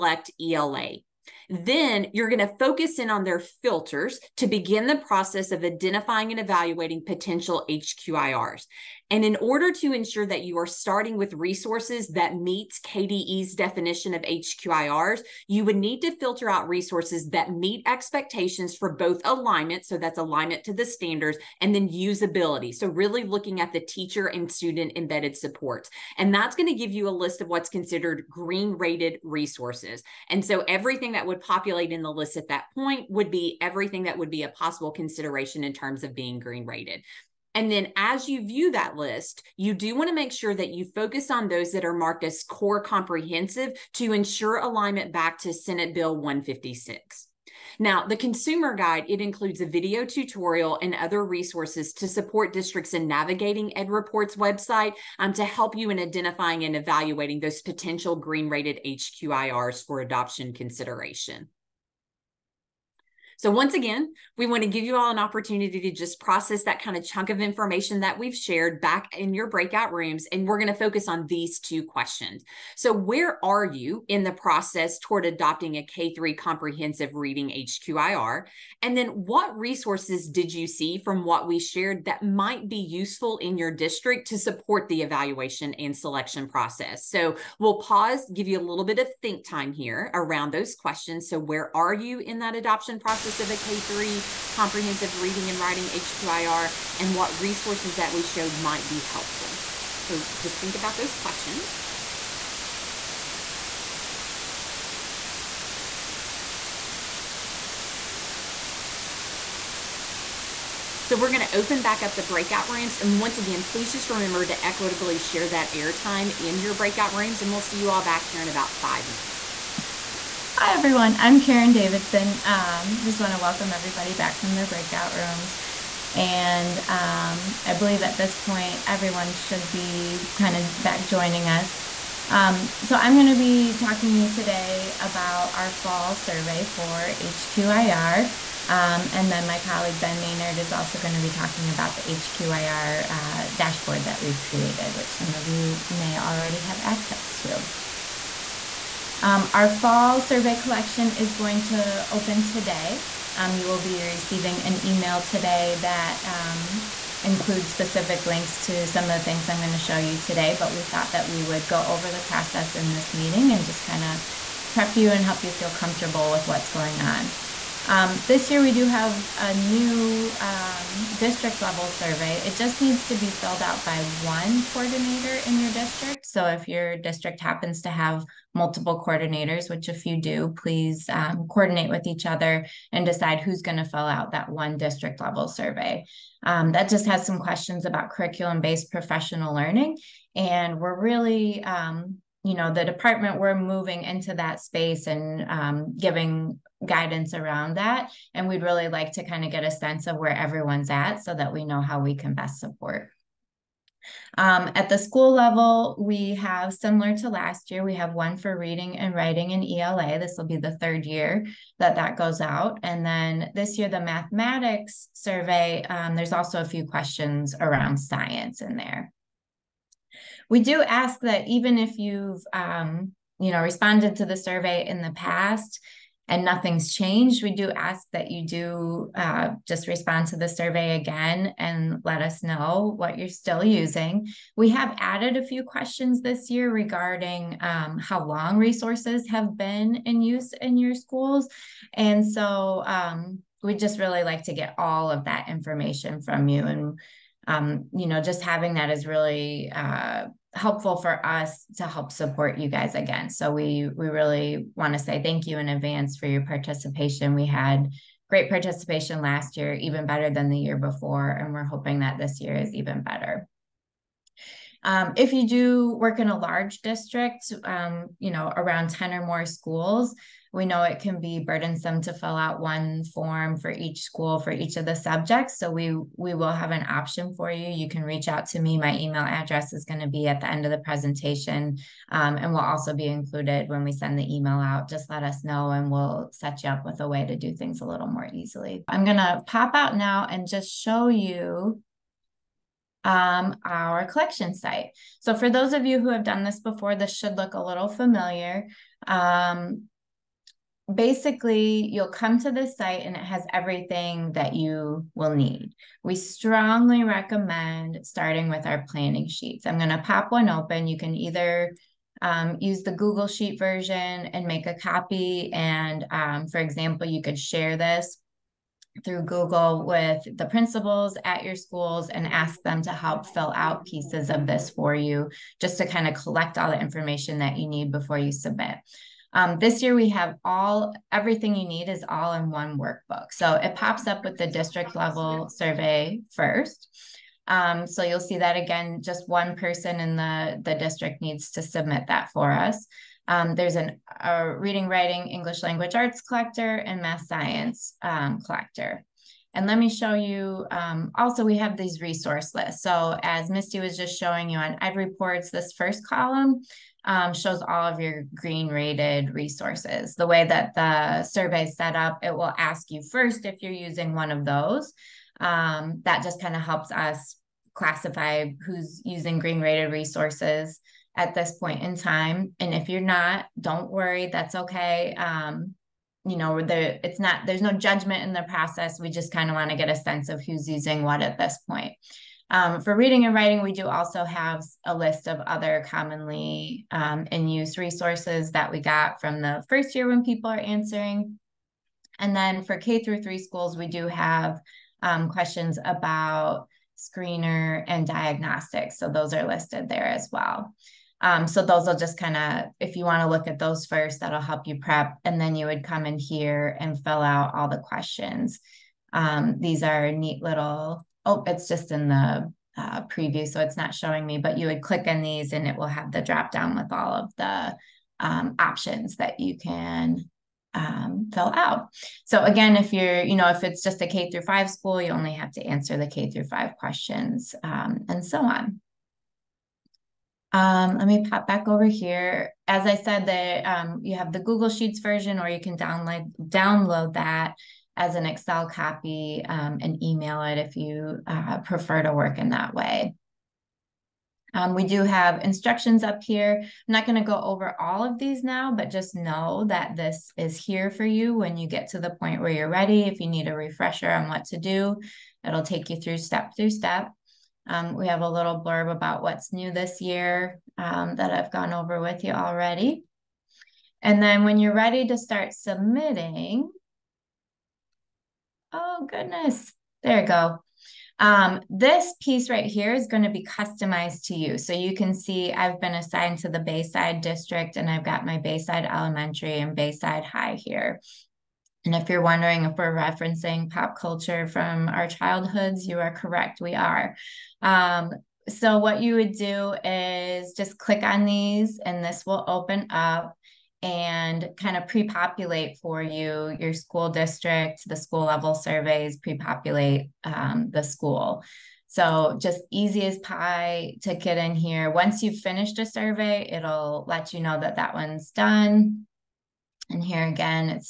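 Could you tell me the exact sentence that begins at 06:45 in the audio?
And then you would come in here and fill out all the questions.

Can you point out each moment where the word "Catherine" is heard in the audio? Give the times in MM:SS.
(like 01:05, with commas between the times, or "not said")
not said.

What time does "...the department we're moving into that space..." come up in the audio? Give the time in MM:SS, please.
03:12.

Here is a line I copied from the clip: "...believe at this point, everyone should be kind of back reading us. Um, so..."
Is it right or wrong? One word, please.
wrong.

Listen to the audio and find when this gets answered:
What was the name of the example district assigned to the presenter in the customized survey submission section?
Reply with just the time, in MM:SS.
07:56.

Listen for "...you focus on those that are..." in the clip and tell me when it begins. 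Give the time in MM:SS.
00:40.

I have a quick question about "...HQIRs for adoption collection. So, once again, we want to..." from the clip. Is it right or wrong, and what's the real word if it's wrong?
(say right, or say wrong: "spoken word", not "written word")
wrong: "consideration", not "collection".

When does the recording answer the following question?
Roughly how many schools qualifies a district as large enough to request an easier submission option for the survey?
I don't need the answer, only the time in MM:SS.
04:28.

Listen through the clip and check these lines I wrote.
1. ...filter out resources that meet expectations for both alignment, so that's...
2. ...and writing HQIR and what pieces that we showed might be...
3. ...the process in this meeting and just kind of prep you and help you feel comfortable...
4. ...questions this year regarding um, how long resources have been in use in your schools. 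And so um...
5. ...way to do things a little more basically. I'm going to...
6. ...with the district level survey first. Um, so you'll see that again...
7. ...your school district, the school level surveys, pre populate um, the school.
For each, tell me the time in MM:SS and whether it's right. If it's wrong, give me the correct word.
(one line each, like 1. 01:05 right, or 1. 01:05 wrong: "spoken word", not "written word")
1. 00:16 right
2. 01:35 wrong: "resources", not "pieces"
3. 02:42 right
4. 03:55 right
5. 04:47 wrong: "easily", not "basically"
6. 05:34 right
7. 08:16 right.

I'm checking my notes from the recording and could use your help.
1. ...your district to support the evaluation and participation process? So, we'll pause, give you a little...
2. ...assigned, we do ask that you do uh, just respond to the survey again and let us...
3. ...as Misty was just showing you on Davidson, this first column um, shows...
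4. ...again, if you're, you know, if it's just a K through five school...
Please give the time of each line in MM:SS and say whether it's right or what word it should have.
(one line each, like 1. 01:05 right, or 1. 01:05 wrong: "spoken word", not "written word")
1. 01:23 wrong: "selection", not "participation"
2. 03:46 wrong: "changed", not "assigned"
3. 05:53 wrong: "EdReports", not "Davidson"
4. 07:02 right.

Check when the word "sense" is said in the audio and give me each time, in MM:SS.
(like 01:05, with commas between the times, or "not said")
03:19, 06:19.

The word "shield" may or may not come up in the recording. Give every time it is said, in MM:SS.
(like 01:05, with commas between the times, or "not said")
not said.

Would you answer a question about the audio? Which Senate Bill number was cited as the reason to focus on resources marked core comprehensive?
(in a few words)
156.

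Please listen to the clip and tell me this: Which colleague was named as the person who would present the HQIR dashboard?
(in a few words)
Ben Maynard.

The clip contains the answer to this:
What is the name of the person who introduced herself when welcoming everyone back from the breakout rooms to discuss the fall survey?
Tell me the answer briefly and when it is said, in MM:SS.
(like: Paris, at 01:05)
Karen Davidson, at 02:01.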